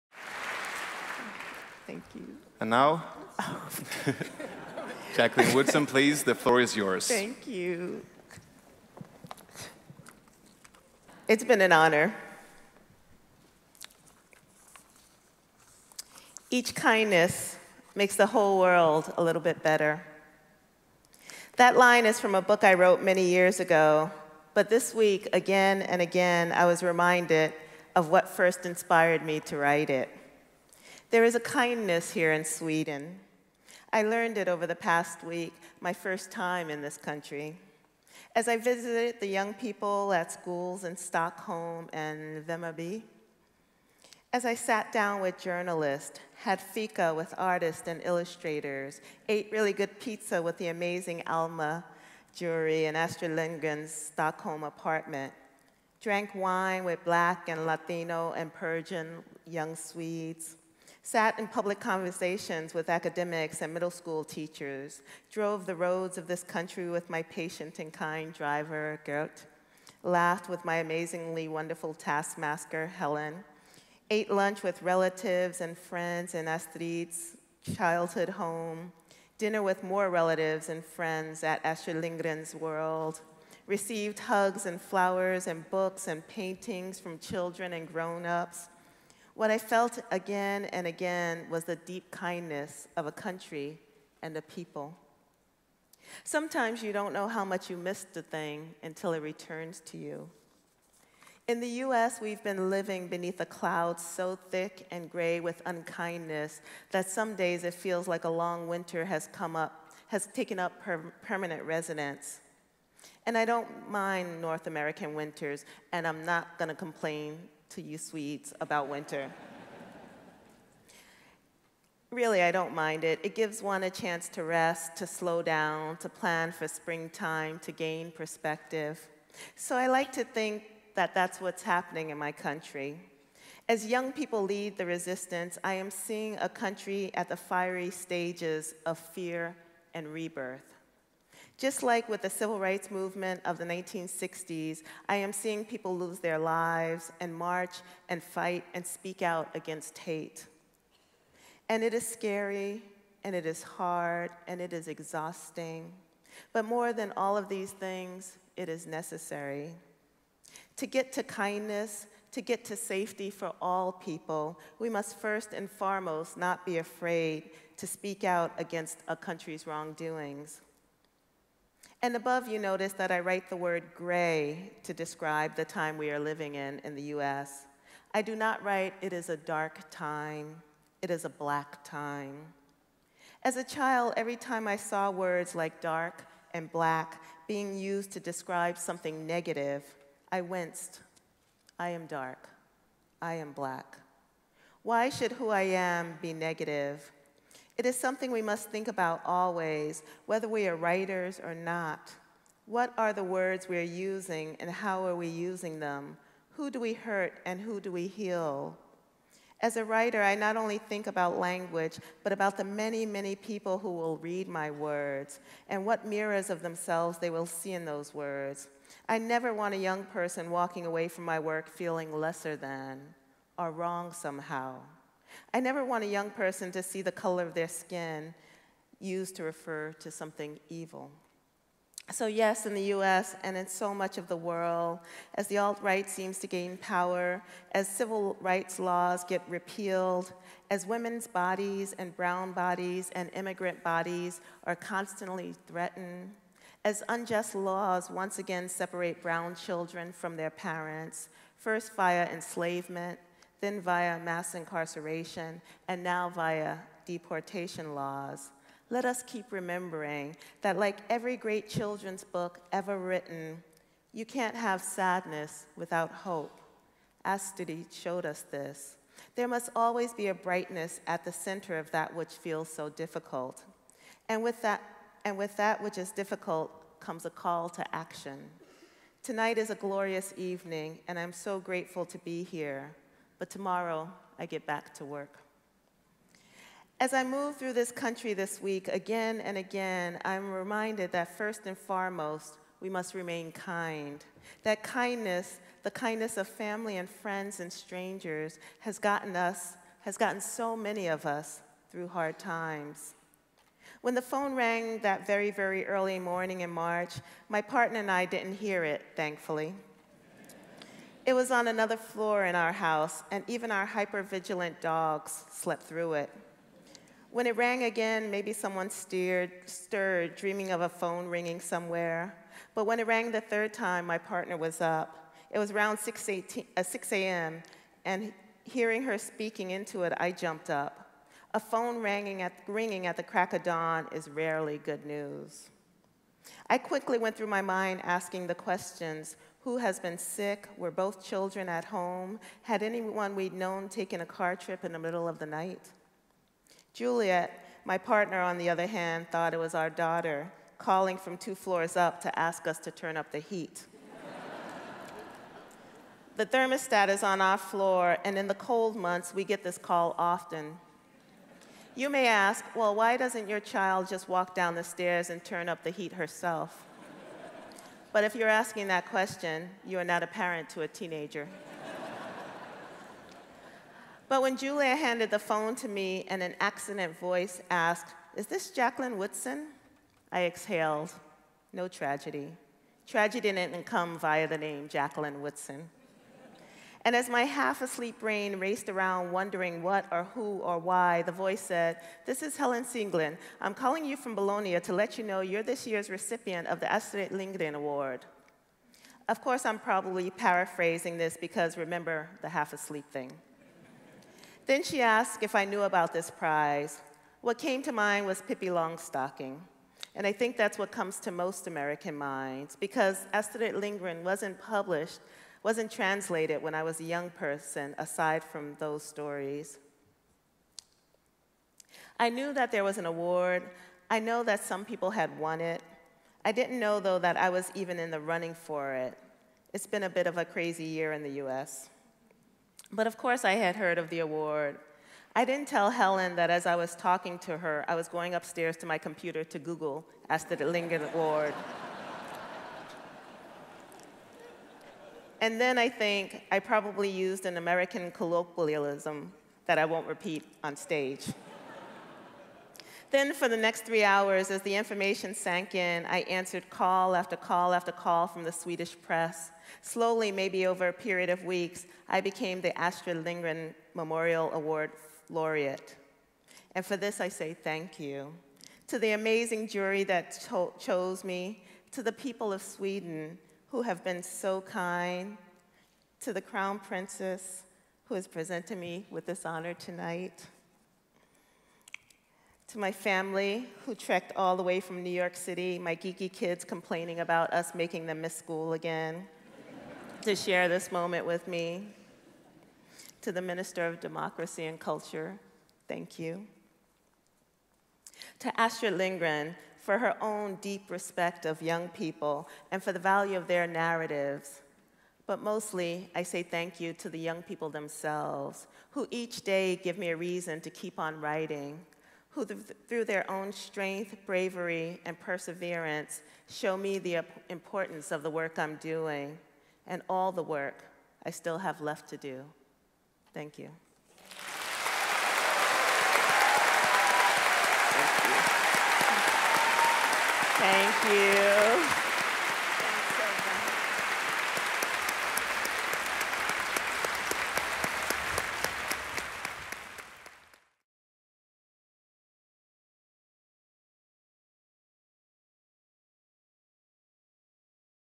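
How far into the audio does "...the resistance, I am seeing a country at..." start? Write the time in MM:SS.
02:14.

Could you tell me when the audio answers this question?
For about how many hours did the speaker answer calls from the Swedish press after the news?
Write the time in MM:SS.
07:33.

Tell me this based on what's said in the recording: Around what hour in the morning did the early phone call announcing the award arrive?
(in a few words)
6 a.m.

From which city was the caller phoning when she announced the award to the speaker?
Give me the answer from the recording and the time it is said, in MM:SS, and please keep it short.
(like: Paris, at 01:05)
Bologna, at 06:34.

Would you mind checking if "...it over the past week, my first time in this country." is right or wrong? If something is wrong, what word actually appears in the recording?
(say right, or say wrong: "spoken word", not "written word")
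right.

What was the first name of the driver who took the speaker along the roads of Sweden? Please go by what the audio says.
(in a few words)
Gert.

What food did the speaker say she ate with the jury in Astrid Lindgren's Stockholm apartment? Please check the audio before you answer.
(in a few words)
pizza.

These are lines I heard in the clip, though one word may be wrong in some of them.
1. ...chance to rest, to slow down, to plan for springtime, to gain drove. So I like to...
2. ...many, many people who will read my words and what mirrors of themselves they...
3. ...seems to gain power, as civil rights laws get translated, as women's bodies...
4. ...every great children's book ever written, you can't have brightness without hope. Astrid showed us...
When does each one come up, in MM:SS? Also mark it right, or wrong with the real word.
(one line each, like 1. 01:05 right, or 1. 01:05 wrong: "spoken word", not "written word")
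1. 02:03 wrong: "perspective", not "drove"
2. 03:32 right
3. 03:56 wrong: "repealed", not "translated"
4. 04:21 wrong: "sadness", not "brightness".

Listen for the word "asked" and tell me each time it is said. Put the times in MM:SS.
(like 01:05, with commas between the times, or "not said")
06:17, 06:45.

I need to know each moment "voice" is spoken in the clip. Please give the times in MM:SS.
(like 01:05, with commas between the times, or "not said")
06:17, 06:31.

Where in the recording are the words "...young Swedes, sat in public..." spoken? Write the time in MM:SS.
00:59.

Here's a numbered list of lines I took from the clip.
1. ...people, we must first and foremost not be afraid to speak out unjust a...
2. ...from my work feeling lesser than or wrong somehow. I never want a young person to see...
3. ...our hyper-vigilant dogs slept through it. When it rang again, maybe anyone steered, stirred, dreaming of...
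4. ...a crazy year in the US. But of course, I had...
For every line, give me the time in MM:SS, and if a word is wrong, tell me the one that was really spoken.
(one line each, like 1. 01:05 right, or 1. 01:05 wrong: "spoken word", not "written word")
1. 02:43 wrong: "against", not "unjust"
2. 03:41 right
3. 05:13 wrong: "someone", not "anyone"
4. 07:10 right.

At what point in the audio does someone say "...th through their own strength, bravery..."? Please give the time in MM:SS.
08:32.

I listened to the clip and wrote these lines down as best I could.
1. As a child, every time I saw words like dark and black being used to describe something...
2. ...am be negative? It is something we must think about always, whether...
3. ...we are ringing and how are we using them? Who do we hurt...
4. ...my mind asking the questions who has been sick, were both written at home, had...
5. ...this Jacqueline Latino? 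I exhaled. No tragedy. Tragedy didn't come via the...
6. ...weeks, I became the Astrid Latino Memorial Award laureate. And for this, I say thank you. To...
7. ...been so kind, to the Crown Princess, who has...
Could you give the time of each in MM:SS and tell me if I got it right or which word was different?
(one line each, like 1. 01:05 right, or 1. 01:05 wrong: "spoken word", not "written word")
1. 03:03 right
2. 03:15 right
3. 03:23 wrong: "using", not "ringing"
4. 05:37 wrong: "children", not "written"
5. 06:18 wrong: "Woodson", not "Latino"
6. 07:41 wrong: "Lindgren", not "Latino"
7. 07:54 right.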